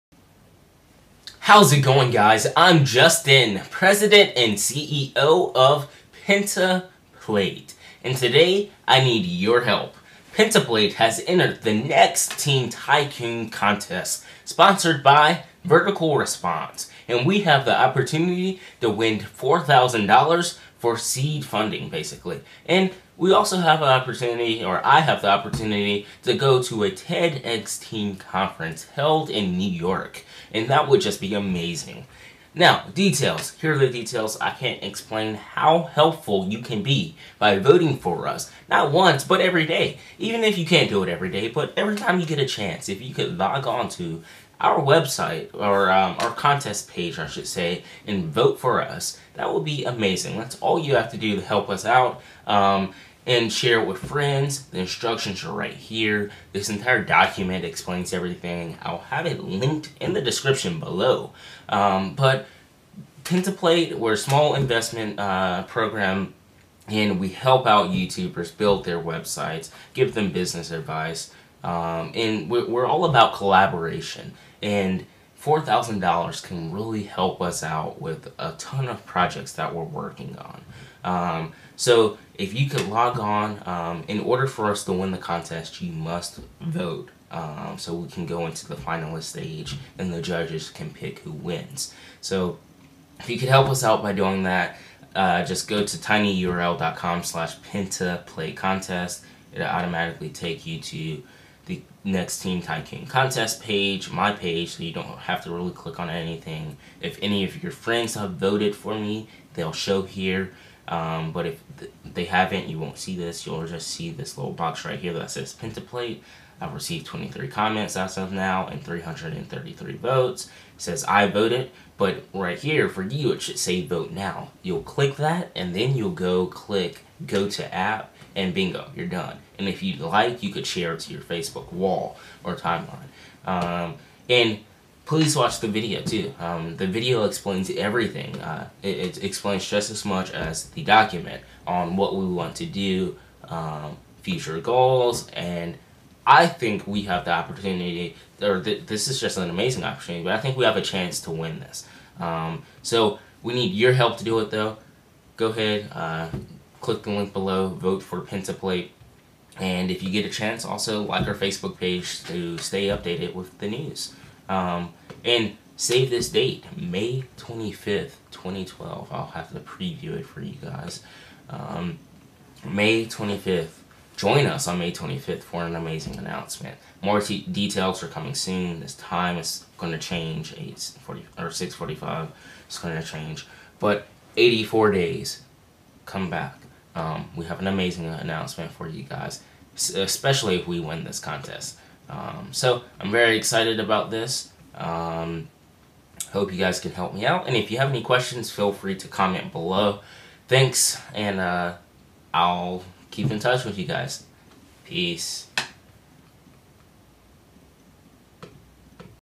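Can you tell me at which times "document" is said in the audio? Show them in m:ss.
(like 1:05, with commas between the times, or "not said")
0:57, 2:20.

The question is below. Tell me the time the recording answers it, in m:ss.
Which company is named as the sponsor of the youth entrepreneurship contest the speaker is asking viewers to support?
0:15.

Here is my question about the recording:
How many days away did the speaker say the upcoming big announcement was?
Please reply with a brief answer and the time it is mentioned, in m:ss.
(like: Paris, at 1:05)
84, at 3:04.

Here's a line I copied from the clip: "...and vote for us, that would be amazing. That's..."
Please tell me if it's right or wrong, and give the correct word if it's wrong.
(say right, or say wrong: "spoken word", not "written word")
right.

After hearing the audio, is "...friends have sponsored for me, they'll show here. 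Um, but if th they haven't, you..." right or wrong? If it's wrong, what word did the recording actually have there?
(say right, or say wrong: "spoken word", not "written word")
wrong: "voted", not "sponsored".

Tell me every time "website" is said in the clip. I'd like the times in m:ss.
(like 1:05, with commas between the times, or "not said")
0:44, 1:08.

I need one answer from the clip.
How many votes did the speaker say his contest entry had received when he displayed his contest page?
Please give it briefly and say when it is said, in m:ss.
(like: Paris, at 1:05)
333, at 1:58.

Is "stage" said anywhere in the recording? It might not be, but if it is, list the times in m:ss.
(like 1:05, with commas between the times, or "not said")
1:29.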